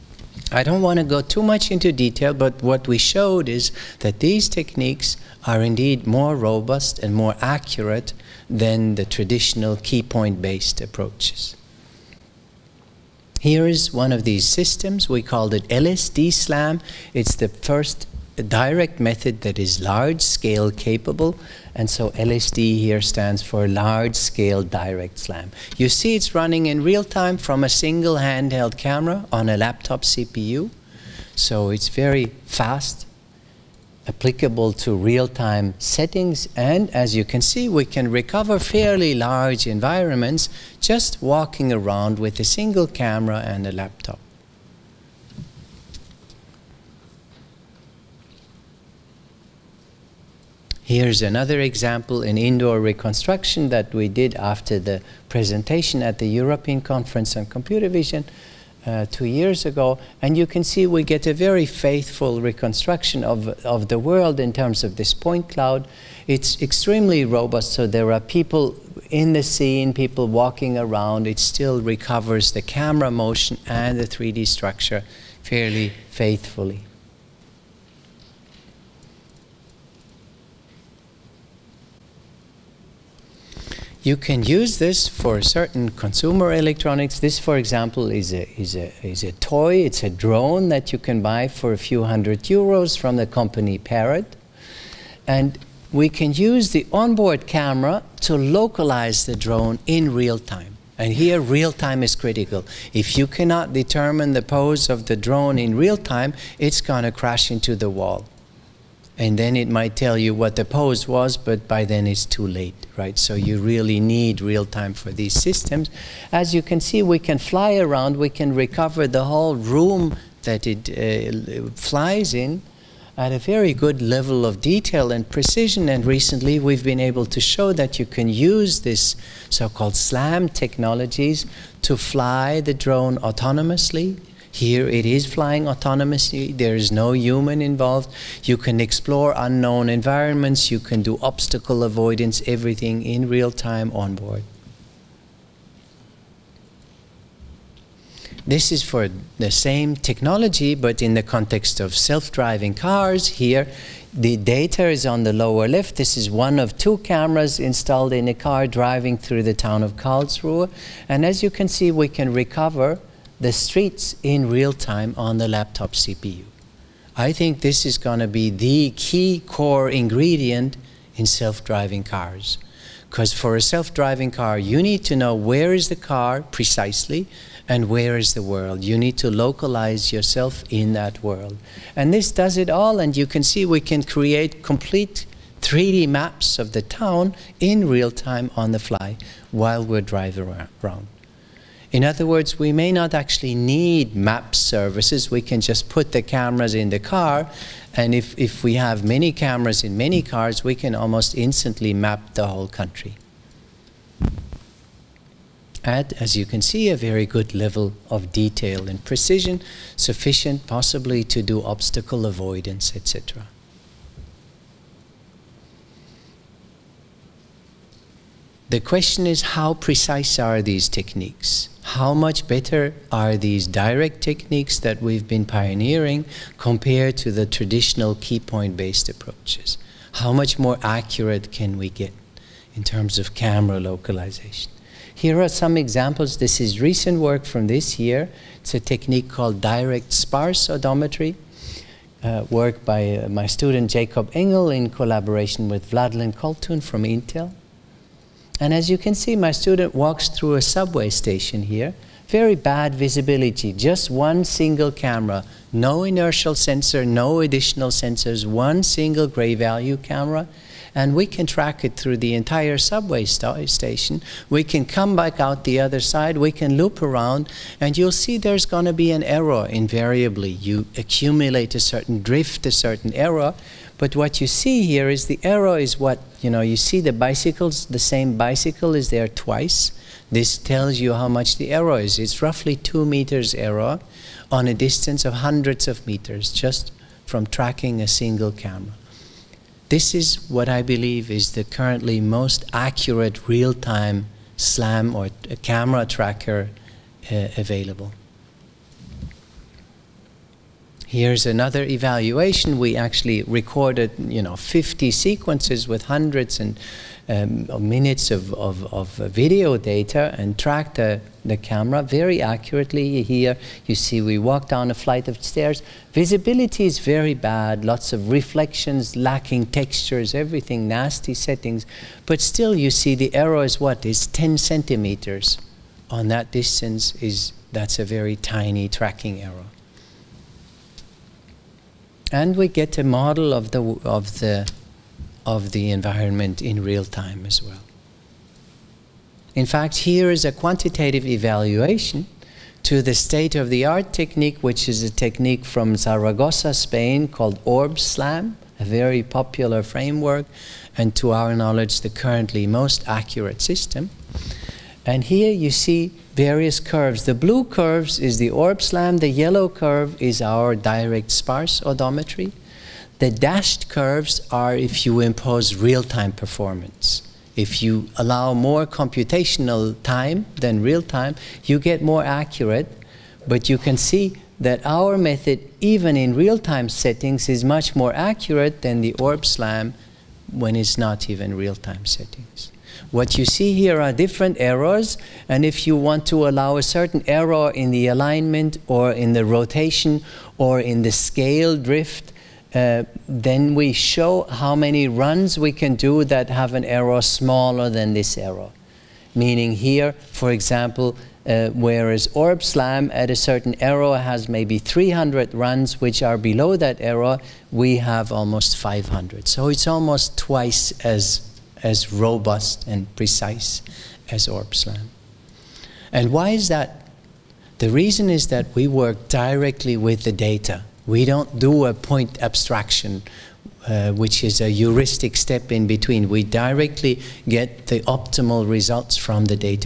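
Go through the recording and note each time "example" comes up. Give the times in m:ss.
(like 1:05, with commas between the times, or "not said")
0:51, 1:27, 3:55, 6:40.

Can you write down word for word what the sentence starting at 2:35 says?
This is one of two cameras installed in a car driving through the town of Karlsruhe.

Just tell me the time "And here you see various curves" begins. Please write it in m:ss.
5:55.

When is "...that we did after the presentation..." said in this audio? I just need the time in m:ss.
0:53.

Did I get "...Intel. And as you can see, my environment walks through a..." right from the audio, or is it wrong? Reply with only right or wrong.
wrong.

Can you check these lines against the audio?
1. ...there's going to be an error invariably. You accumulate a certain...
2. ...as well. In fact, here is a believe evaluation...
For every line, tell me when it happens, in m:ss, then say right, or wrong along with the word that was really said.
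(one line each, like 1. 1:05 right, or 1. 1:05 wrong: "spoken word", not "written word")
1. 4:28 right
2. 5:37 wrong: "quantitative", not "believe".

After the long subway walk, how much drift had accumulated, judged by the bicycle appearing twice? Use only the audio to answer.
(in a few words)
2 meters.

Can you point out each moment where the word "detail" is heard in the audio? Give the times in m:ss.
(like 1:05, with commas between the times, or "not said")
0:01, 2:04, 3:28.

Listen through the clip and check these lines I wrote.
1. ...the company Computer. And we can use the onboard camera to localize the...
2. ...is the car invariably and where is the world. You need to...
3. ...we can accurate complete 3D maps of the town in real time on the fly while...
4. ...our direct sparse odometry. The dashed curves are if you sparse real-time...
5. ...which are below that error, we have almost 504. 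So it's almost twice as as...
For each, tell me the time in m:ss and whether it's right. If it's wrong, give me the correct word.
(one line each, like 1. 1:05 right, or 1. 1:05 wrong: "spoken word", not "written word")
1. 1:33 wrong: "Parrot", not "Computer"
2. 2:55 wrong: "precisely", not "invariably"
3. 3:03 wrong: "create", not "accurate"
4. 6:00 wrong: "impose", not "sparse"
5. 6:46 wrong: "500", not "504".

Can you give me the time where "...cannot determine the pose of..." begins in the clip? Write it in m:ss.
1:43.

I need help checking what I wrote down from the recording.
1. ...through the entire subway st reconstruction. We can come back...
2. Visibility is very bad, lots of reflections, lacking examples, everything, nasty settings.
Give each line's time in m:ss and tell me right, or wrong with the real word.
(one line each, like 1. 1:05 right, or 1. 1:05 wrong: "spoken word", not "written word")
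1. 4:21 wrong: "station", not "reconstruction"
2. 5:16 wrong: "textures", not "examples".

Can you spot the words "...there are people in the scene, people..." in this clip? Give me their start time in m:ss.
1:07.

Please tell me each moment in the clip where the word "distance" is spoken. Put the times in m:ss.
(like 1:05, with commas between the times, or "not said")
4:44, 5:26.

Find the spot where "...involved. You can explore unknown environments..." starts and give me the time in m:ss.
2:17.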